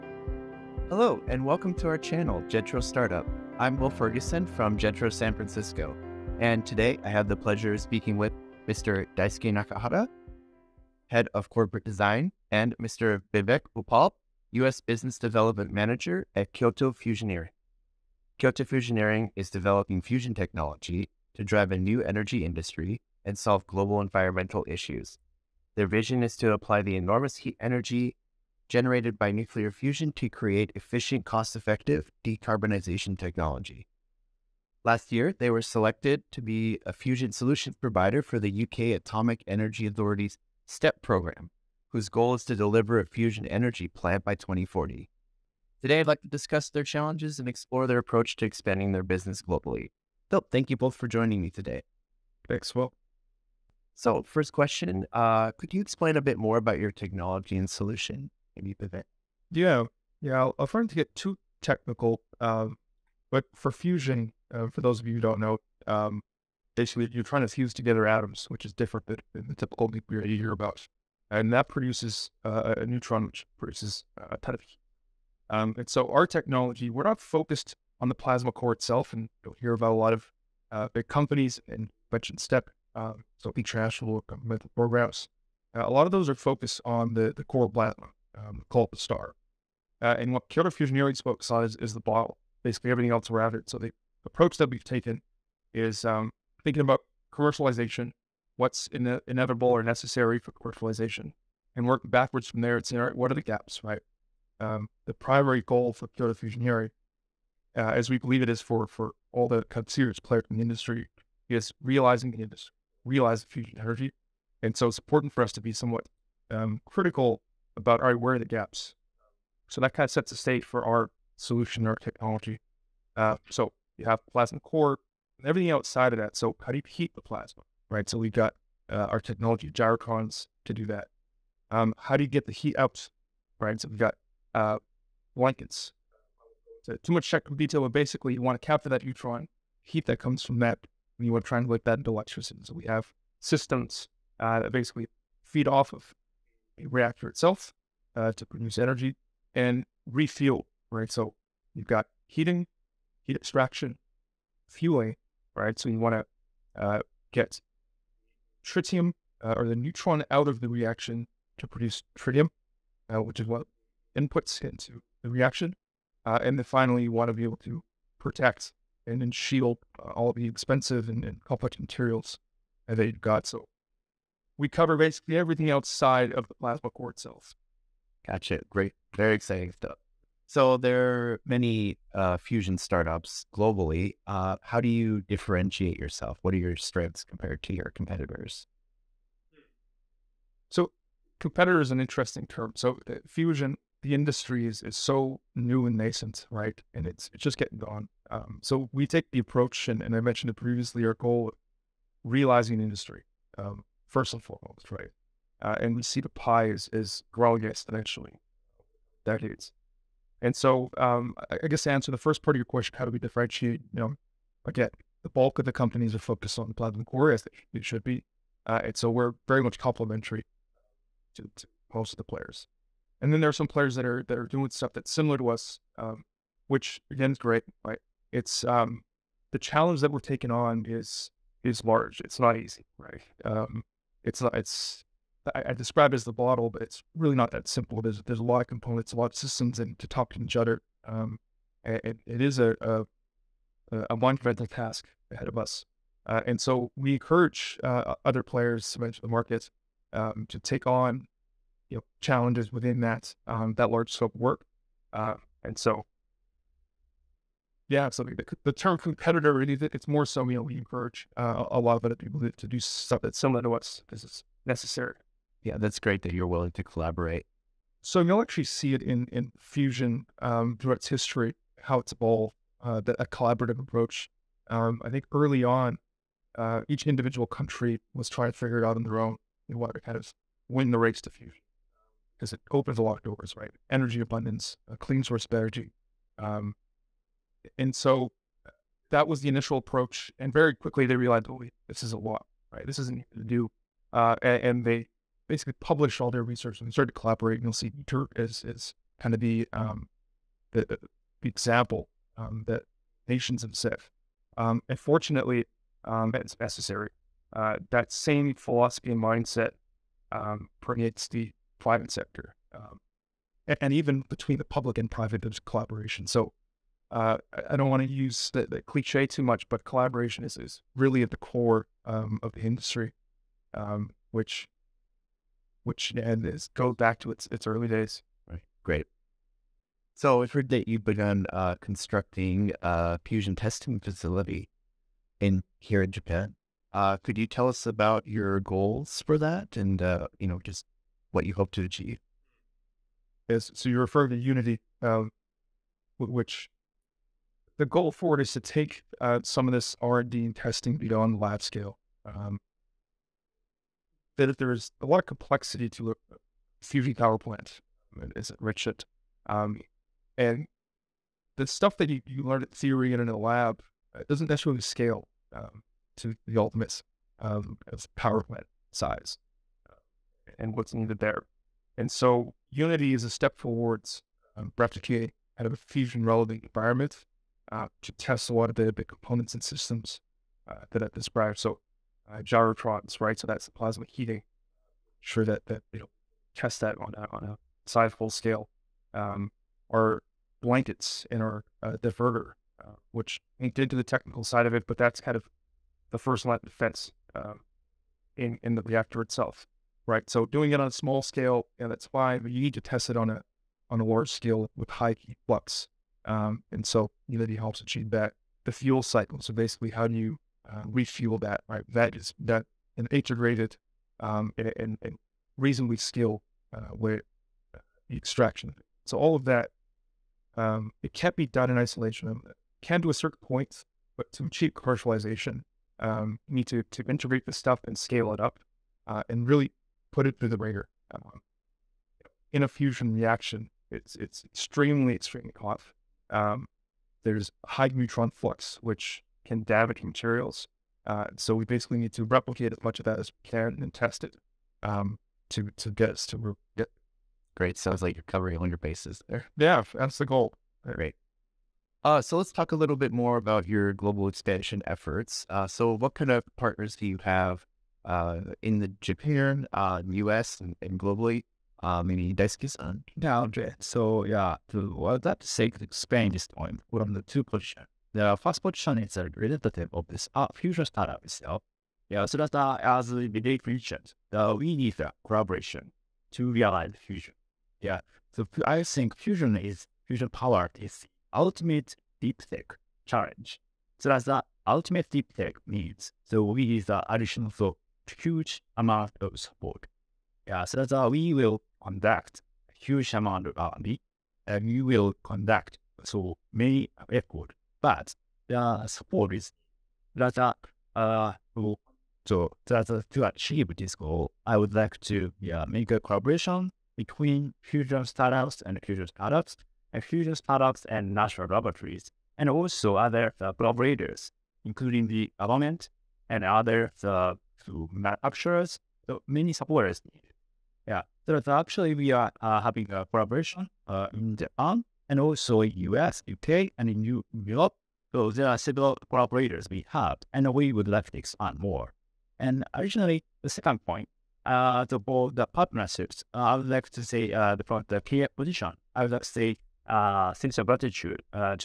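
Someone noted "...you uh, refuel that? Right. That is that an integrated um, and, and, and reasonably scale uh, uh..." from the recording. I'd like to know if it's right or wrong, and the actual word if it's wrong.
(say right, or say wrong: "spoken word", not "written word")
right.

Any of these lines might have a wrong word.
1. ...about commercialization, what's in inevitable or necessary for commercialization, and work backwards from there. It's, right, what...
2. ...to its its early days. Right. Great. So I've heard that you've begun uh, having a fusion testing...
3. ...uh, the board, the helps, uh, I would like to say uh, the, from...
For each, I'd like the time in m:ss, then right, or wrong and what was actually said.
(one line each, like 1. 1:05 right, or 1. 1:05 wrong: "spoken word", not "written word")
1. 1:36 right
2. 5:27 wrong: "constructing", not "having"
3. 8:54 wrong: "partnerships", not "helps".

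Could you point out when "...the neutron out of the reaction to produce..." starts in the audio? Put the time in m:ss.
2:39.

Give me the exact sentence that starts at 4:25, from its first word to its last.
Yeah, that's great that you're willing to collaborate.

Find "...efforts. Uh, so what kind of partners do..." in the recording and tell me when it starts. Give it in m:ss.
7:34.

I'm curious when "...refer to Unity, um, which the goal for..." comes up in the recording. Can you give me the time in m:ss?
5:43.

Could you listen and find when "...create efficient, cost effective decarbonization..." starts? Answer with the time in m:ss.
0:30.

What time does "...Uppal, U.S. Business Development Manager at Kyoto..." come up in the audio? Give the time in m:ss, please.
0:13.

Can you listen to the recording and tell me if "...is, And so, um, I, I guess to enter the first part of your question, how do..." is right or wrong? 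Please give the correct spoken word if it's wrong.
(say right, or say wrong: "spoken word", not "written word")
wrong: "answer", not "enter".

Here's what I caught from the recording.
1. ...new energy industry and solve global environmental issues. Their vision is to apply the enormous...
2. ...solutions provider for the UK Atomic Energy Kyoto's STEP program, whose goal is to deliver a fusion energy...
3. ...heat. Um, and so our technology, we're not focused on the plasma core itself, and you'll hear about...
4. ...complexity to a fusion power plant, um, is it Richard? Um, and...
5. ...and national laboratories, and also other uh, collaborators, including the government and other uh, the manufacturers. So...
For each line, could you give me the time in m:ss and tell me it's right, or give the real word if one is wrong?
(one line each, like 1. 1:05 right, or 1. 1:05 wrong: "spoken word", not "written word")
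1. 0:21 right
2. 0:37 wrong: "Authority", not "Kyoto"
3. 1:14 right
4. 5:55 right
5. 8:30 right.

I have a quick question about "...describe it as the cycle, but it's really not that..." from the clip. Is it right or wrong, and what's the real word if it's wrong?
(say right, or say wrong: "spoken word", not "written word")
wrong: "bottle", not "cycle".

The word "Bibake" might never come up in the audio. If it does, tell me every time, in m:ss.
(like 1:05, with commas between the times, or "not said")
0:13, 7:53.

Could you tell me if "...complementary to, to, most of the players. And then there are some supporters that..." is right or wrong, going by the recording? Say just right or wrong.
wrong.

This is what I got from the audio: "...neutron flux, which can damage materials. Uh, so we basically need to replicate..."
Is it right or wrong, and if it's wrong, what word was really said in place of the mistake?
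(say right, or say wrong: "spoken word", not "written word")
right.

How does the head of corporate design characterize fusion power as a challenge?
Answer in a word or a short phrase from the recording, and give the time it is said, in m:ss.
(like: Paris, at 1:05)
ultimate deep tech challenge, at 8:01.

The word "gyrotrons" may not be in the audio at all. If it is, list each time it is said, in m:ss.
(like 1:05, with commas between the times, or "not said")
2:09, 6:22.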